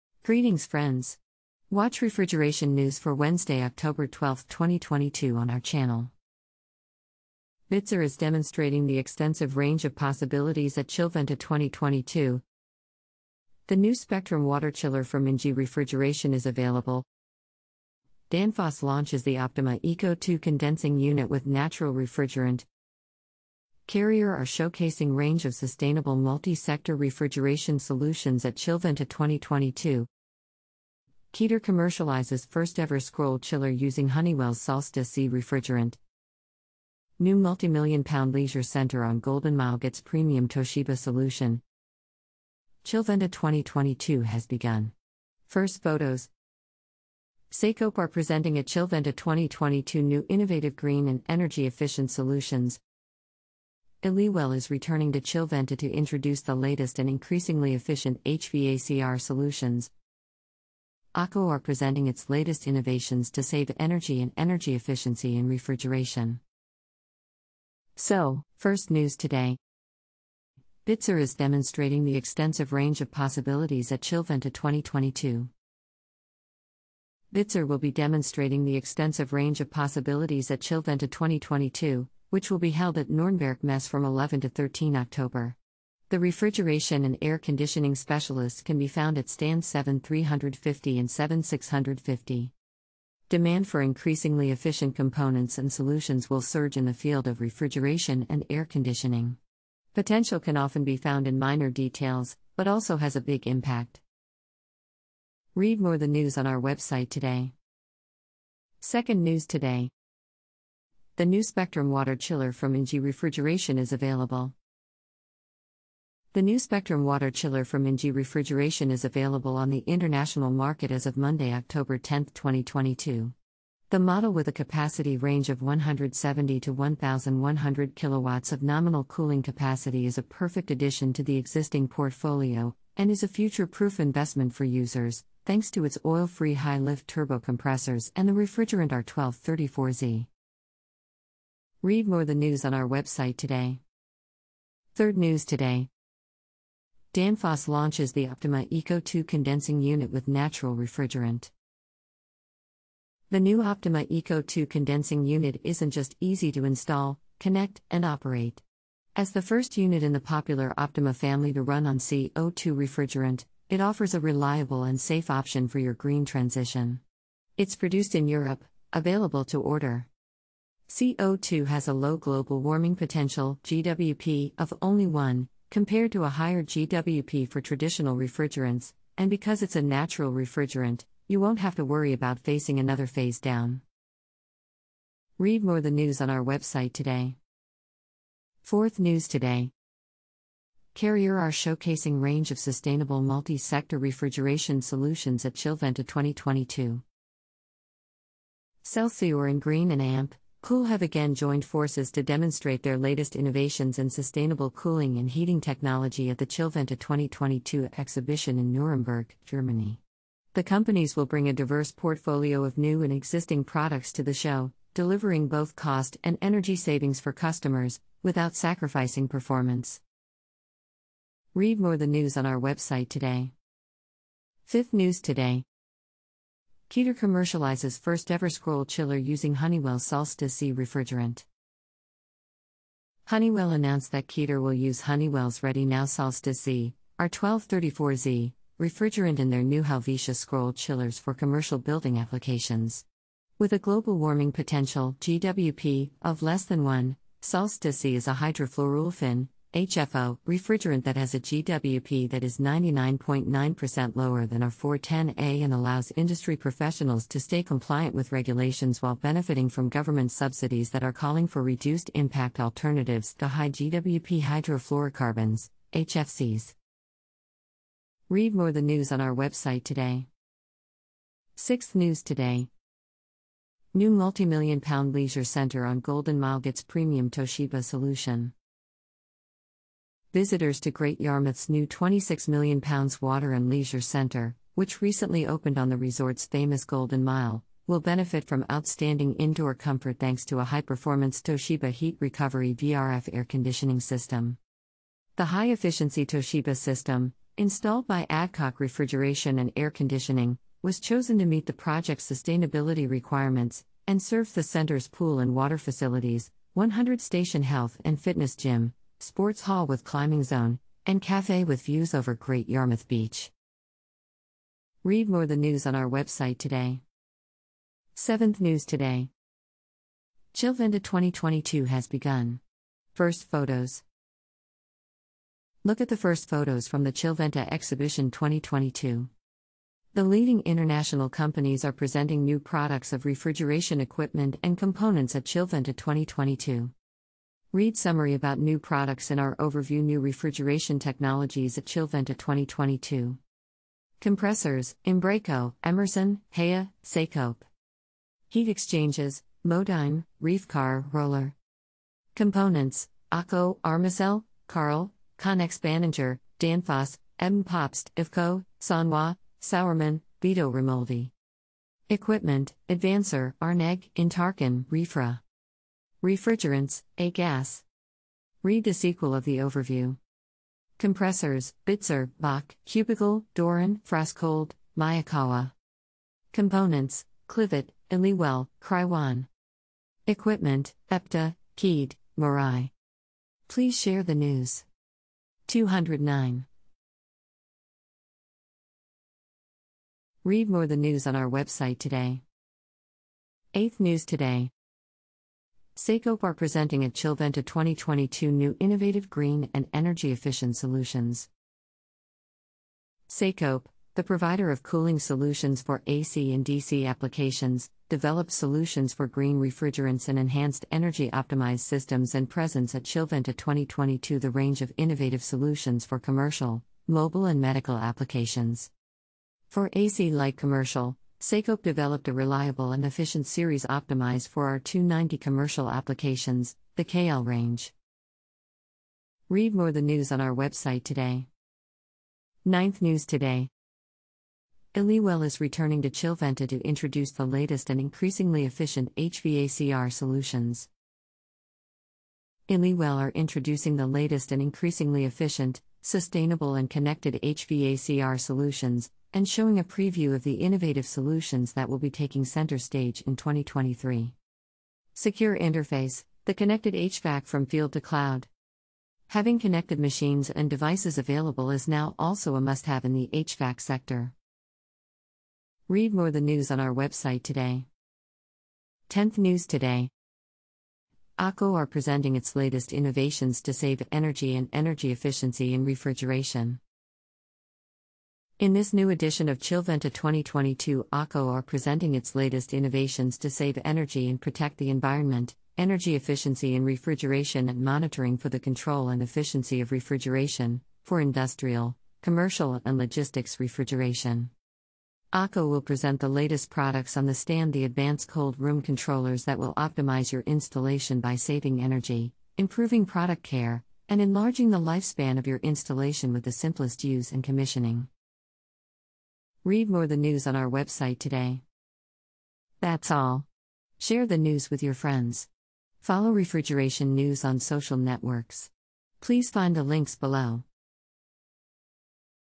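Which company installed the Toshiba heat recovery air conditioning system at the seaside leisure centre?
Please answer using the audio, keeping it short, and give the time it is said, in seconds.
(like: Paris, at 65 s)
Adcock Refrigeration and Air Conditioning, at 298 s.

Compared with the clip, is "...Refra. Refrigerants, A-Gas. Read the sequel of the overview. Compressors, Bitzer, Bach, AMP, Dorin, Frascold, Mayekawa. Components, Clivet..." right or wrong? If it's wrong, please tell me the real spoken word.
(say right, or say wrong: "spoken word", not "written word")
wrong: "Cubicle", not "AMP".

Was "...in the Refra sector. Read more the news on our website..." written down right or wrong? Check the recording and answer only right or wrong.
wrong.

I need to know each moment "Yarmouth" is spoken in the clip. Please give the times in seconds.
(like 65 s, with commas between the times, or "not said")
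281 s, 312 s.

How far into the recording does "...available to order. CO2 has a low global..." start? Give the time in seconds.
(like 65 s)
168 s.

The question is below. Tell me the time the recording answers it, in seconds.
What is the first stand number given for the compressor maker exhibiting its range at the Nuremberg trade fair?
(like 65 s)
89 s.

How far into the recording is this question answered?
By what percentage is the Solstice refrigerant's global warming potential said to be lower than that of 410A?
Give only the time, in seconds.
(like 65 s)
252 s.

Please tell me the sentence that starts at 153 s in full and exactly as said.
The new Optyma iCO2 condensing unit isn't just easy to install, connect, and operate.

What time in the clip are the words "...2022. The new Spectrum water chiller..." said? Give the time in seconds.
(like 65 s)
11 s.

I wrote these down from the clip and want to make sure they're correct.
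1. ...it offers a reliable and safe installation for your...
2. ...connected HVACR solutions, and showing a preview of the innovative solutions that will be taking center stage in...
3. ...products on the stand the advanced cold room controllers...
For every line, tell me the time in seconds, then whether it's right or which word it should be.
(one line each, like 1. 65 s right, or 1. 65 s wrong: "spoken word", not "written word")
1. 163 s wrong: "option", not "installation"
2. 446 s right
3. 496 s right.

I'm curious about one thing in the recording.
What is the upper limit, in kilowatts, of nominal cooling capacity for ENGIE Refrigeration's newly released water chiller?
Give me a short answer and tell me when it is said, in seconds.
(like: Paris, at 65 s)
1100, at 126 s.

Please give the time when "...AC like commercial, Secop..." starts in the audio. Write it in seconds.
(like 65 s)
419 s.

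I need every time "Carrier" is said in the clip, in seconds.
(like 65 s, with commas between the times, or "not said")
23 s, 190 s.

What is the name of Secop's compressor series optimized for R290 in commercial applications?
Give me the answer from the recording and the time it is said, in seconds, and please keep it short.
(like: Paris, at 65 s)
KL range, at 426 s.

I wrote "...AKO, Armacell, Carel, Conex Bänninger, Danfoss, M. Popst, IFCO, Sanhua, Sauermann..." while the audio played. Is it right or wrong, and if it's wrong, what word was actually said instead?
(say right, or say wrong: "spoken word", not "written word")
right.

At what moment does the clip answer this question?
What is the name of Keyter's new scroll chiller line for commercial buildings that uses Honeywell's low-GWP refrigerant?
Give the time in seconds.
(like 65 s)
239 s.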